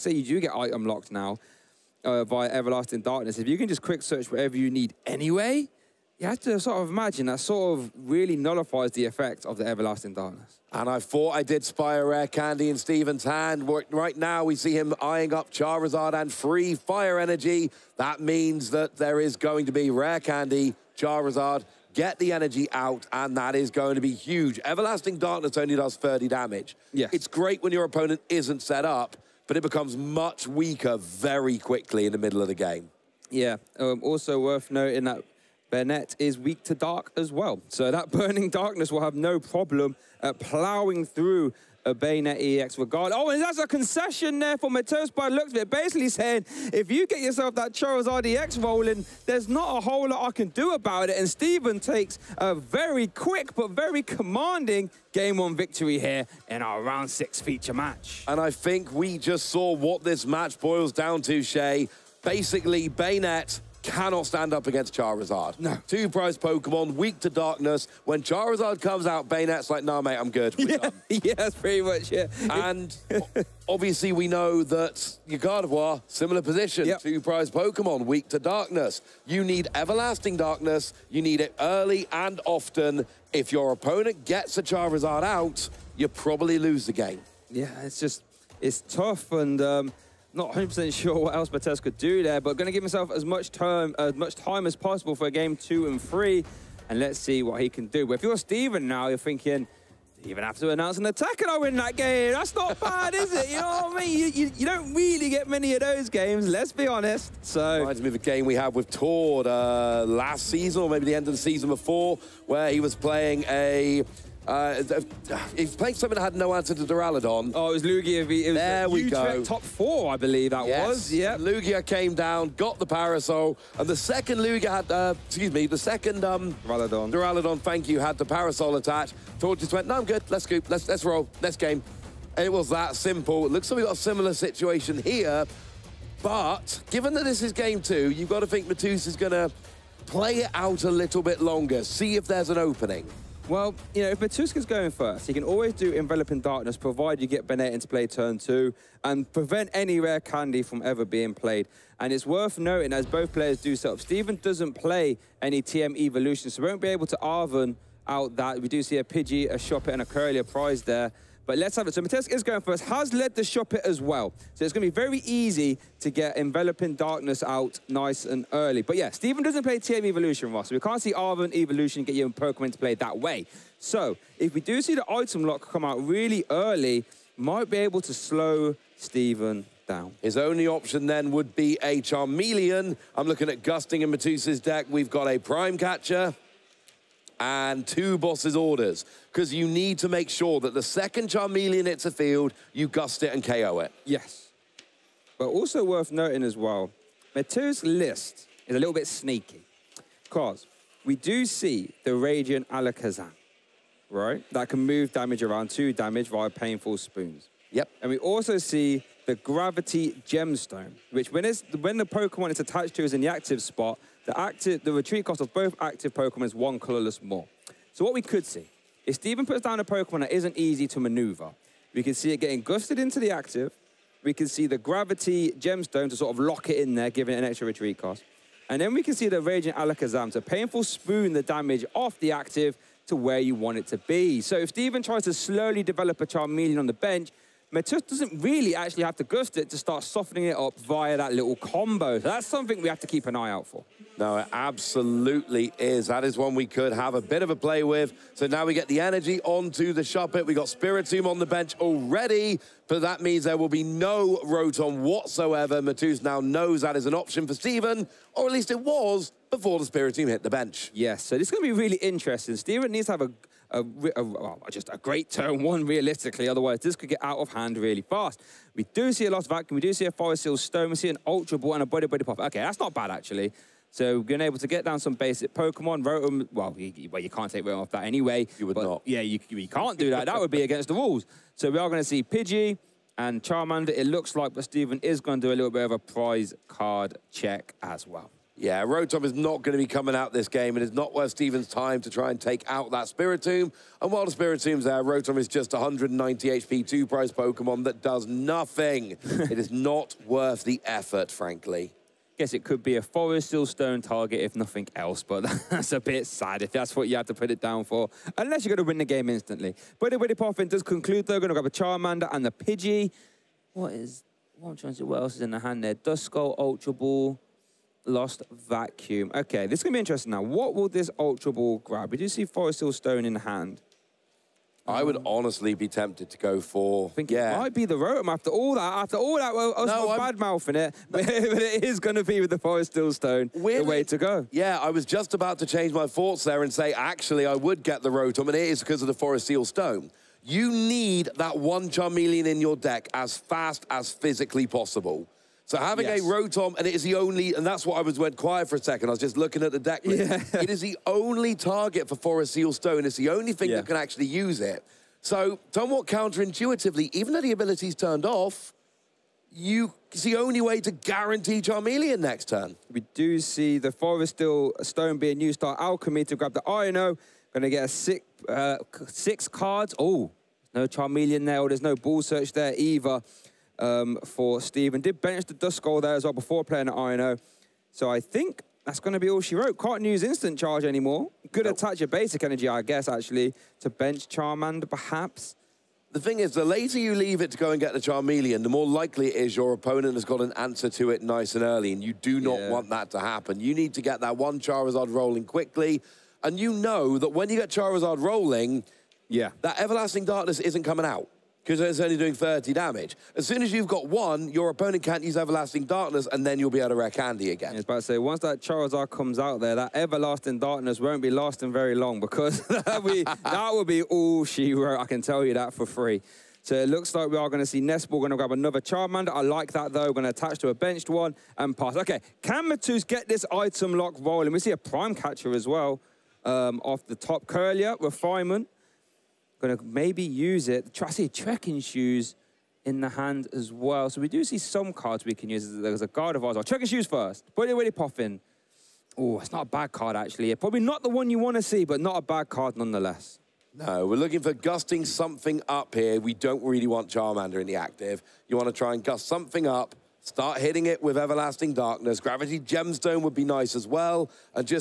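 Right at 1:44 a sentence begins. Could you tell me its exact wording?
You, you, you, don't really get many of those games, let's be honest.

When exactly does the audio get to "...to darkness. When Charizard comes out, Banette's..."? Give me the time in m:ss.
1:07.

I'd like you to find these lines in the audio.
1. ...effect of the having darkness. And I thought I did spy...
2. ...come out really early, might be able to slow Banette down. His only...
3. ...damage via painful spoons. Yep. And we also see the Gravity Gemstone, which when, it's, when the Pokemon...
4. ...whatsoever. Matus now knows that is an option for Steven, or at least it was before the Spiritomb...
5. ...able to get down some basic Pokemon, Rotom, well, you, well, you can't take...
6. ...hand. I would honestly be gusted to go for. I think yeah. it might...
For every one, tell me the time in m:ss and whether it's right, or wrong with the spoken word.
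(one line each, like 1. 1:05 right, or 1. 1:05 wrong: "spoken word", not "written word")
1. 0:09 wrong: "everlasting", not "having"
2. 2:55 wrong: "Steven", not "Banette"
3. 3:25 right
4. 4:15 right
5. 4:34 right
6. 5:23 wrong: "tempted", not "gusted".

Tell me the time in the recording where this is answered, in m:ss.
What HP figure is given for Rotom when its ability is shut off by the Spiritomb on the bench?
4:55.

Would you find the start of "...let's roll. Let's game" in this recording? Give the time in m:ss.
2:10.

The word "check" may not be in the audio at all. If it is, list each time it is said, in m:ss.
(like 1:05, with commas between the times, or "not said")
4:47, 7:16.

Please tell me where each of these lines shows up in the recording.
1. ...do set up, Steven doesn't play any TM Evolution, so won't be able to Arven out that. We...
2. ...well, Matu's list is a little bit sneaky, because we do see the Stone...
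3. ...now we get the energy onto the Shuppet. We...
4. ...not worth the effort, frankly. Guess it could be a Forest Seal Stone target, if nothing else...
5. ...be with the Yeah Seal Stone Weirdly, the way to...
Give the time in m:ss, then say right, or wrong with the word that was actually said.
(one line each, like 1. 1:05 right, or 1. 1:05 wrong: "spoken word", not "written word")
1. 2:33 right
2. 3:16 wrong: "Radiant", not "Stone"
3. 4:08 right
4. 4:59 right
5. 5:32 wrong: "Forest", not "Yeah".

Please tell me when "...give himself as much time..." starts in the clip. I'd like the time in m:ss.
1:32.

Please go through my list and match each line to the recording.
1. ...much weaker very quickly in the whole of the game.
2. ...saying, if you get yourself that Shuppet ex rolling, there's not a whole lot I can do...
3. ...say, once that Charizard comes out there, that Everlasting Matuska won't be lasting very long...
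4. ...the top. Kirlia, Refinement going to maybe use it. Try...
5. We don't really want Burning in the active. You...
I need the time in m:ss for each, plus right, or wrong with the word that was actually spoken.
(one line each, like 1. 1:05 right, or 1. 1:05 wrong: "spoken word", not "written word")
1. 0:29 wrong: "middle", not "whole"
2. 0:46 wrong: "Charizard", not "Shuppet"
3. 6:48 wrong: "Darkness", not "Matuska"
4. 7:07 right
5. 7:26 wrong: "Charmander", not "Burning".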